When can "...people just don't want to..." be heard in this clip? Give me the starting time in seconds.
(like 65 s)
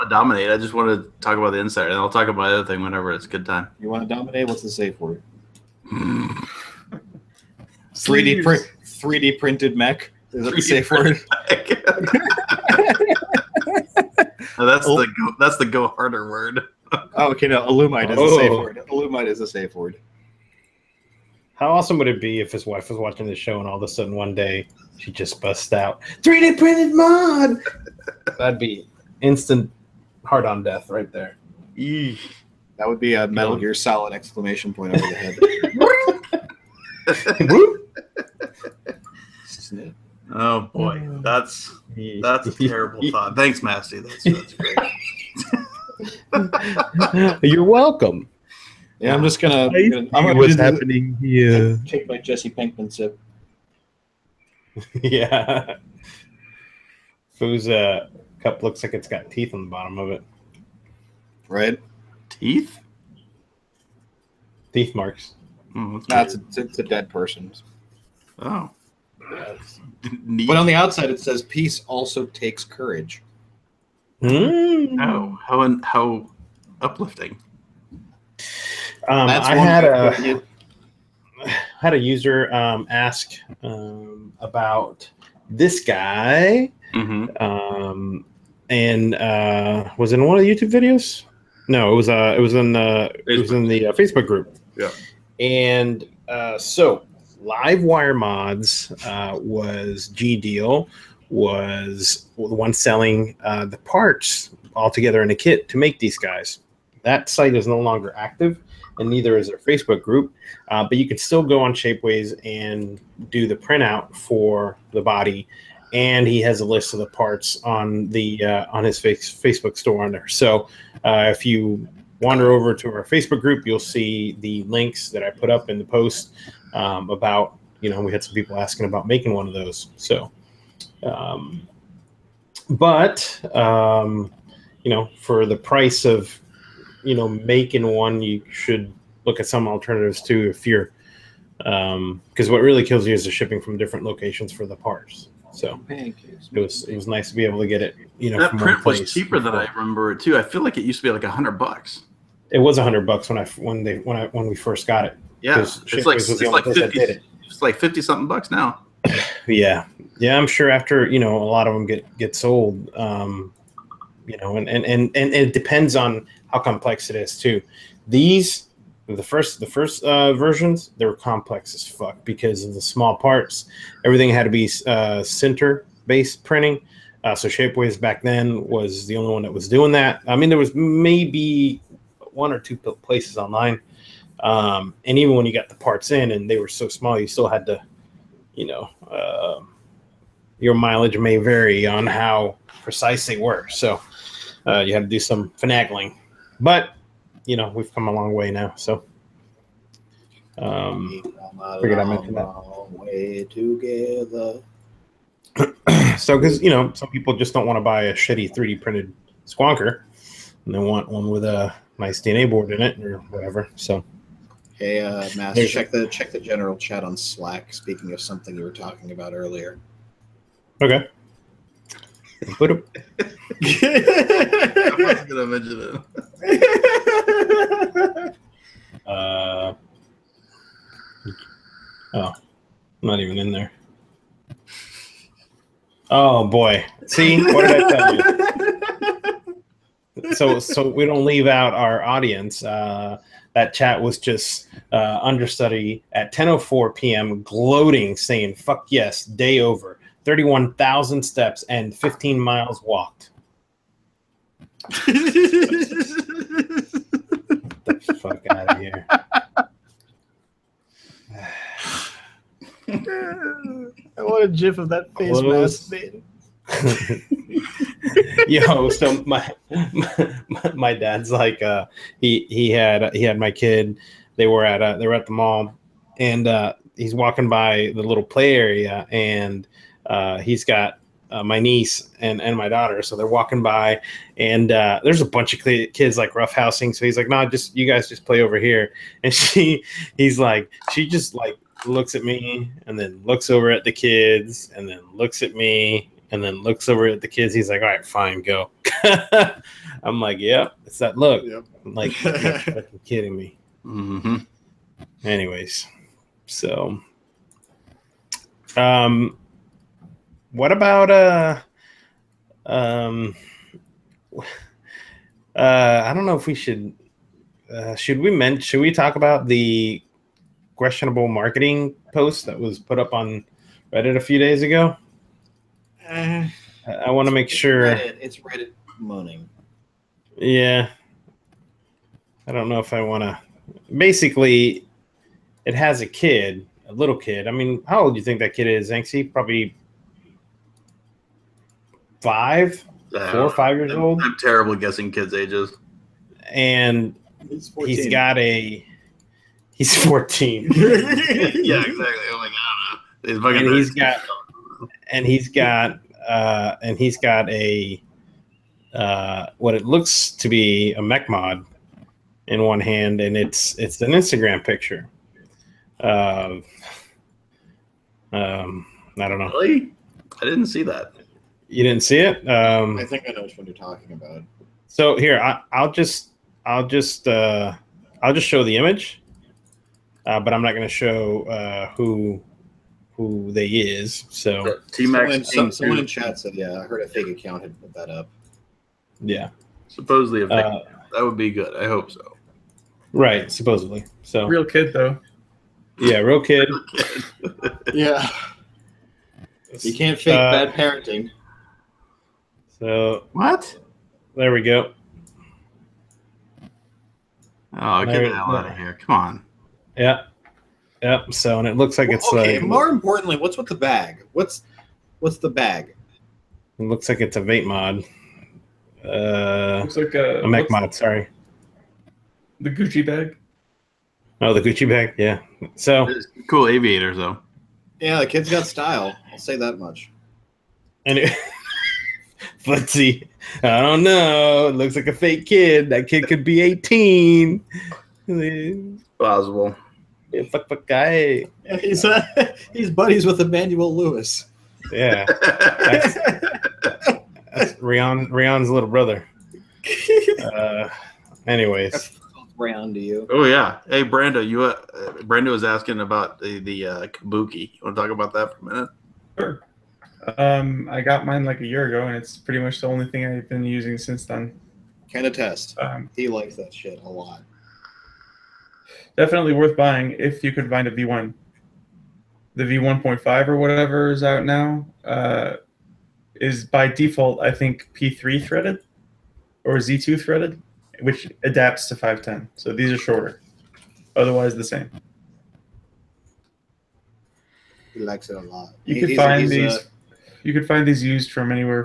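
207 s.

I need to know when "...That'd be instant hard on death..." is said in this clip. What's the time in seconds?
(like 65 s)
28 s.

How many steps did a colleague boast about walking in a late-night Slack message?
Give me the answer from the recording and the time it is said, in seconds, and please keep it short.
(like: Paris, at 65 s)
31,000, at 250 s.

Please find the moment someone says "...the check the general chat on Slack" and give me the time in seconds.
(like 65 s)
215 s.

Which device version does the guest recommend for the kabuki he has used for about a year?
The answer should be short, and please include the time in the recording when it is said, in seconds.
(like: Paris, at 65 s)
V1, at 470 s.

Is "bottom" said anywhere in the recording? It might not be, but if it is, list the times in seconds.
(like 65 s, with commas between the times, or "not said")
59 s.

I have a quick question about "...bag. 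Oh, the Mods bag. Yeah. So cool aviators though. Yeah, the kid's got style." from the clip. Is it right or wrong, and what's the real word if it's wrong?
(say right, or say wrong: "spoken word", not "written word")
wrong: "Gucci", not "Mods".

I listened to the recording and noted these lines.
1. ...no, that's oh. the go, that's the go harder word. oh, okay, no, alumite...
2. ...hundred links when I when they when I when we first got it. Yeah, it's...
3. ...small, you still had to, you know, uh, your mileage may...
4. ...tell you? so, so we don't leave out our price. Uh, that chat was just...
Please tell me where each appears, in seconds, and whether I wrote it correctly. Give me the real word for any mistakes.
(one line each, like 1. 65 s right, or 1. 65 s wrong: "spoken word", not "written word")
1. 14 s right
2. 152 s wrong: "bucks", not "links"
3. 186 s right
4. 239 s wrong: "audience", not "price".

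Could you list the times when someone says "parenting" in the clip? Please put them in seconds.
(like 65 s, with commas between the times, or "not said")
400 s.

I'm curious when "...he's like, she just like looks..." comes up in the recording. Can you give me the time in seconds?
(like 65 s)
290 s.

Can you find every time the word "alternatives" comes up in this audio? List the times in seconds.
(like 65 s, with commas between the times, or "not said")
139 s.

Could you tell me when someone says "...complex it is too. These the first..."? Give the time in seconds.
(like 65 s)
166 s.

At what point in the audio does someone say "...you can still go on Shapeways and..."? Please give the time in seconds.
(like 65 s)
110 s.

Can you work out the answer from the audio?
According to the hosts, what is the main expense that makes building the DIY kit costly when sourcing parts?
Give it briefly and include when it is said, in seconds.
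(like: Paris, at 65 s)
Shipping, at 143 s.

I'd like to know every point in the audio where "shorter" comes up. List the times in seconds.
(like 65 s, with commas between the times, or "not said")
482 s.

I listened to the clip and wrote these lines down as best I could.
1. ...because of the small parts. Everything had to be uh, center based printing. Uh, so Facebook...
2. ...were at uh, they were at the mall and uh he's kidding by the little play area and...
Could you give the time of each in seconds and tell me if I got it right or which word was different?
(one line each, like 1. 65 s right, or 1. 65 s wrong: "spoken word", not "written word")
1. 172 s wrong: "Shapeways", not "Facebook"
2. 274 s wrong: "walking", not "kidding".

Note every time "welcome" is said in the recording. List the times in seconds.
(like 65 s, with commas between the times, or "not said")
47 s.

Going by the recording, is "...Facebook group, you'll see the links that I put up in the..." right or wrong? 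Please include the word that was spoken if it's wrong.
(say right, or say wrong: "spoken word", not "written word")
right.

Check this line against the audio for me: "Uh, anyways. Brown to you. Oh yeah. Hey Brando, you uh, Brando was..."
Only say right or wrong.
right.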